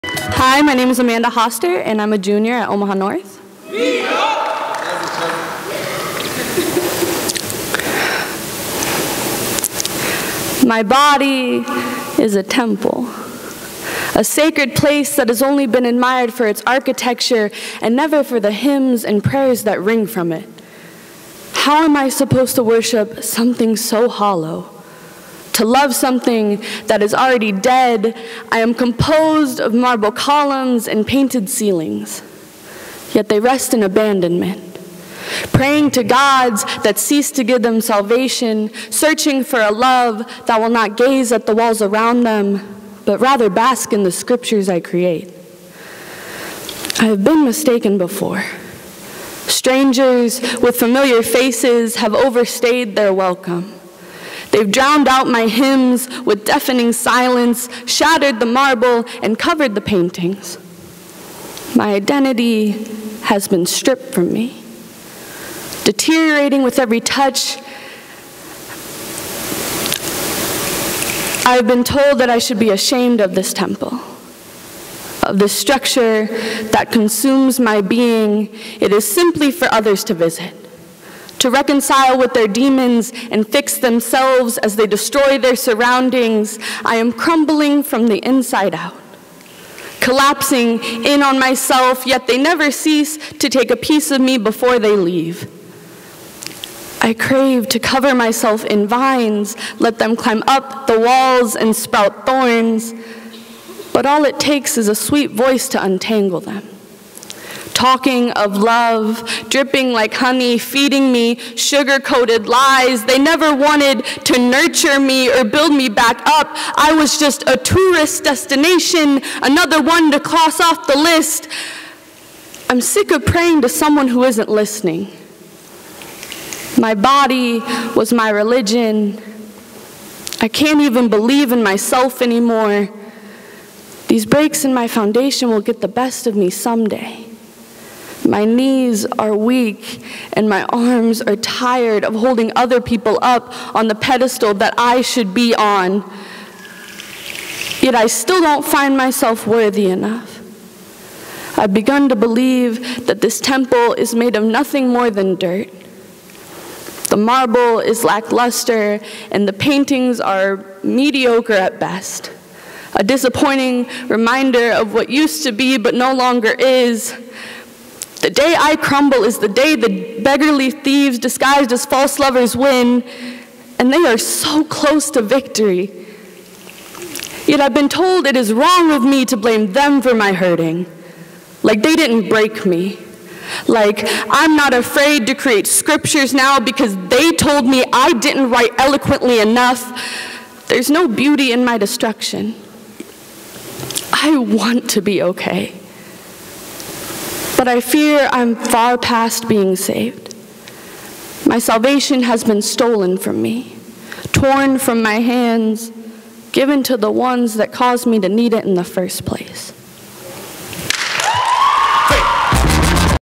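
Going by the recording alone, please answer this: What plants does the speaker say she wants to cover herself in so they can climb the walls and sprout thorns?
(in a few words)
vines.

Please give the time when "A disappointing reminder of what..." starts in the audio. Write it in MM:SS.
02:42.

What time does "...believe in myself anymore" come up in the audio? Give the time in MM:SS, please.
02:11.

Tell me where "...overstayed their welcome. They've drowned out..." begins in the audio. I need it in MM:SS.
00:52.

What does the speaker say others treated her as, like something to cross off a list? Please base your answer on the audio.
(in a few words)
a tourist destination.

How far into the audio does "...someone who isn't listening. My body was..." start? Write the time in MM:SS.
02:03.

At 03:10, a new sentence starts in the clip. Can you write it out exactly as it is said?
There's no beauty in my destruction.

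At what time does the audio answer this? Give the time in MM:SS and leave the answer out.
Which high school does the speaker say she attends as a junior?
00:02.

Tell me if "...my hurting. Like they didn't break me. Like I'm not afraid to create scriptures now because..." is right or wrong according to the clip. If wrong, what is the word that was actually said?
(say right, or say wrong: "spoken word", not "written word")
right.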